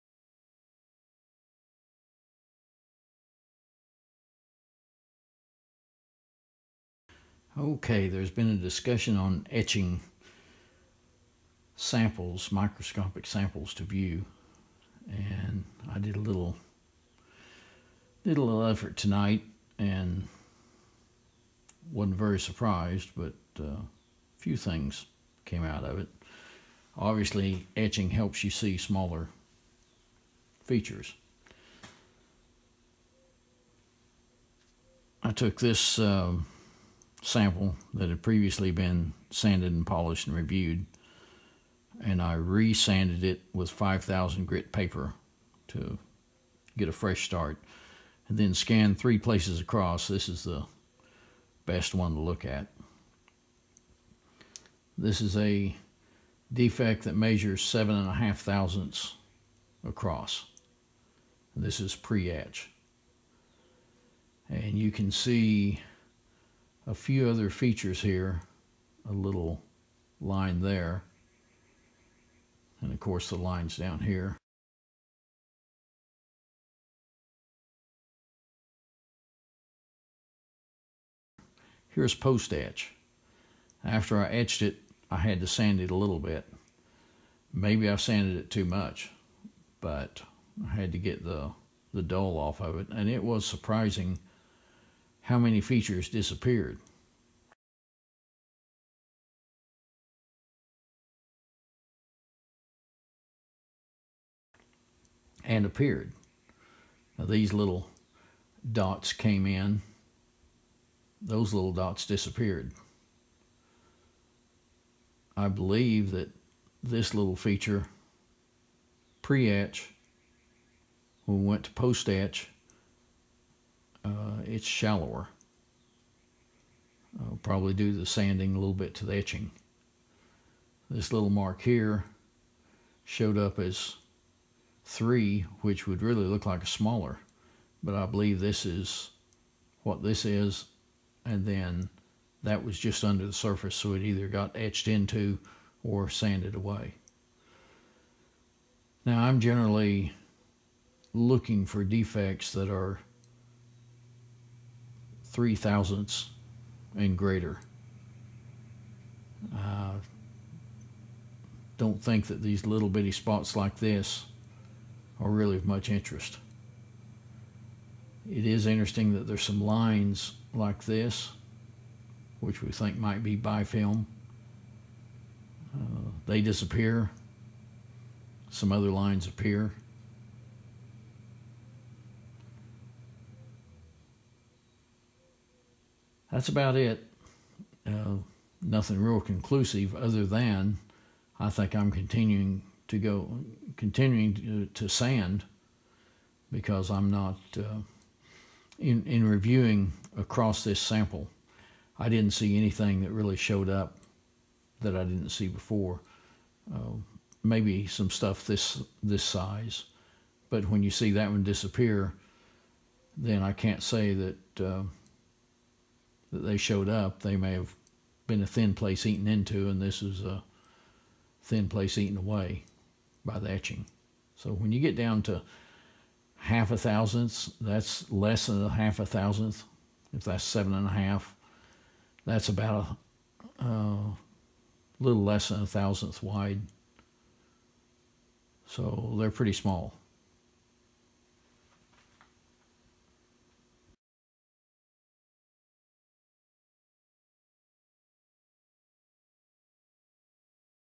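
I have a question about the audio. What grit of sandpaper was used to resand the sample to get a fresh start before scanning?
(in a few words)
5,000.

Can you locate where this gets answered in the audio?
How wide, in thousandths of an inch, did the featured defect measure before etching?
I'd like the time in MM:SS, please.
00:57.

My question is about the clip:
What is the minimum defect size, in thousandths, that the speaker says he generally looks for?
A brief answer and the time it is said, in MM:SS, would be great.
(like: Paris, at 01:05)
3 thousandths, at 02:35.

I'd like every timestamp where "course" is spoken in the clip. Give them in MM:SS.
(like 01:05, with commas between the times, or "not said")
01:12.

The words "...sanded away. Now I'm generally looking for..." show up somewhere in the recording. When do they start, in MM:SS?
02:26.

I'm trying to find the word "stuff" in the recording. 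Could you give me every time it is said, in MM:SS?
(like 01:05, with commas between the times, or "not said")
03:28.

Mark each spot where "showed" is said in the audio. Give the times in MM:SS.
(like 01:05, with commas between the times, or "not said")
02:13, 03:23, 03:36.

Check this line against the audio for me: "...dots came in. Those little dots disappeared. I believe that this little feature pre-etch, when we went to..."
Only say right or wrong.
right.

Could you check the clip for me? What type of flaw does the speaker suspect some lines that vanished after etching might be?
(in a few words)
bifilm.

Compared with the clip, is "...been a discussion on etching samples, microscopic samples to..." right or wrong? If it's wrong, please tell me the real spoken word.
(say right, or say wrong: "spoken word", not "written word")
right.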